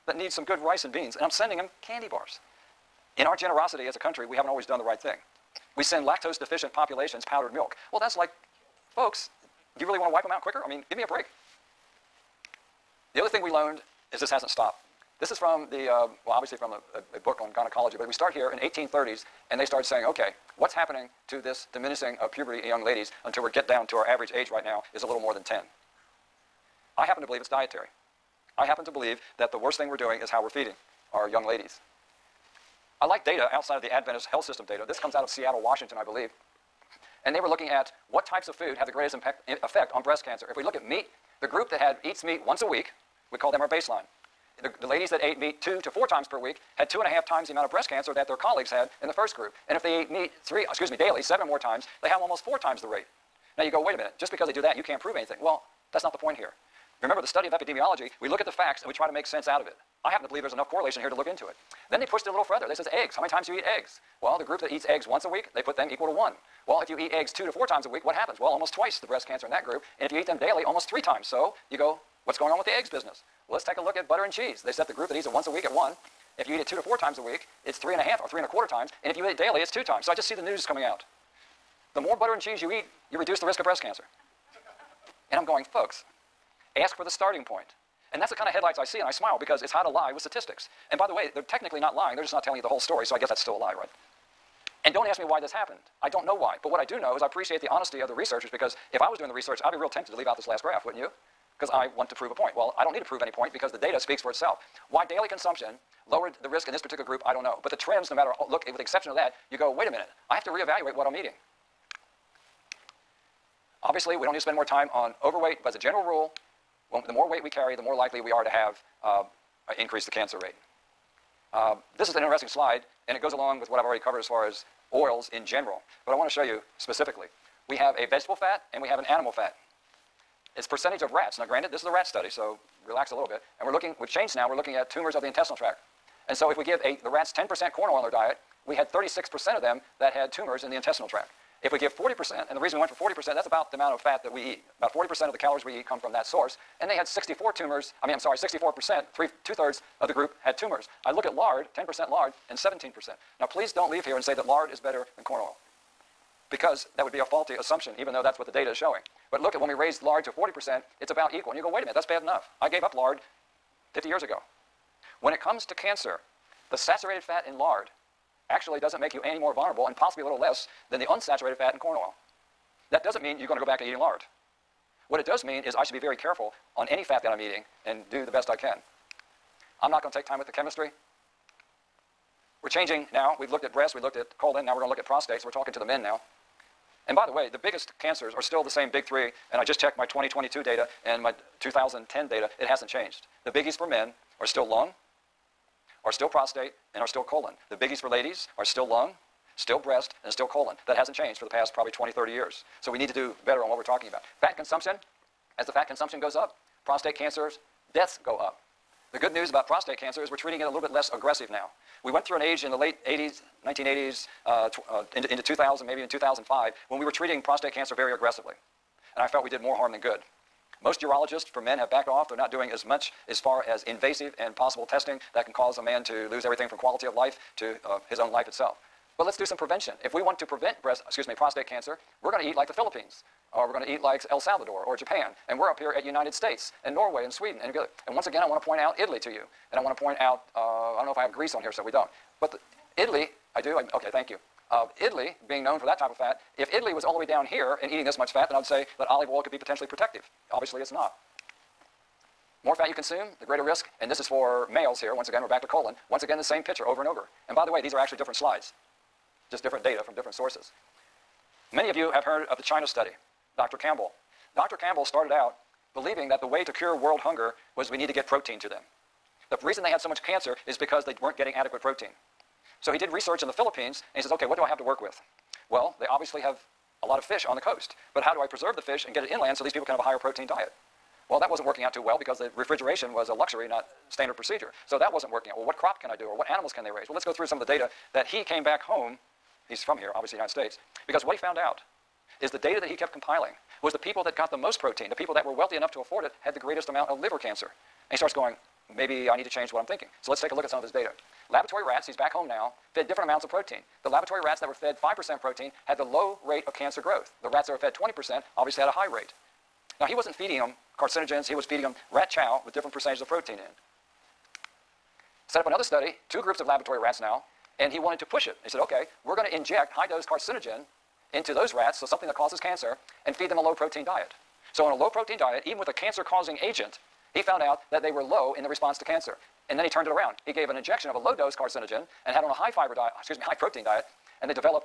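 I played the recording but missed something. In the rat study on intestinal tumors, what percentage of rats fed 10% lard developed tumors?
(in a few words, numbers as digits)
17%.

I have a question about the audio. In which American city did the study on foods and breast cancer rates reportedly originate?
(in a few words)
Seattle.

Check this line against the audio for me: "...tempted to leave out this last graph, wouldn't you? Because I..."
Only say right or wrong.
right.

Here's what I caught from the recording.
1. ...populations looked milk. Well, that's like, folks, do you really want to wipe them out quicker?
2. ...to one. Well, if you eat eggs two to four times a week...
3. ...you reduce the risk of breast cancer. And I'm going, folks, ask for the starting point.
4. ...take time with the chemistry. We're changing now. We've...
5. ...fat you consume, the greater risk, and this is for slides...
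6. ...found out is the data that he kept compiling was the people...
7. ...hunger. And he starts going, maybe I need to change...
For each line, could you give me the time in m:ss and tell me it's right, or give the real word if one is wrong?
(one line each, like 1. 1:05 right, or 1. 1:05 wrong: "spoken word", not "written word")
1. 0:06 wrong: "powdered", not "looked"
2. 1:06 right
3. 1:23 right
4. 3:00 right
5. 4:12 wrong: "males", not "slides"
6. 4:51 right
7. 4:57 wrong: "cancer", not "hunger".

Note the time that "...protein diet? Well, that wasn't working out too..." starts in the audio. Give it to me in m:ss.
4:40.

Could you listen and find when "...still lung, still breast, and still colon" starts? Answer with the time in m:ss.
3:18.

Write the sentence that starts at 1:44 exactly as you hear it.
Why daily consumption lowered the risk in this particular group, I don't know.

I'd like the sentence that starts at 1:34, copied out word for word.
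And don't ask me why this happened.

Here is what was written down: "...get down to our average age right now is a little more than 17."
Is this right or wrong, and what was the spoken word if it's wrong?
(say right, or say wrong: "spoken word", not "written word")
wrong: "10", not "17".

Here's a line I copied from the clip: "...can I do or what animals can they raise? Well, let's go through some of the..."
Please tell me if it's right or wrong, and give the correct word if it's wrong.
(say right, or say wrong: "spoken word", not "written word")
right.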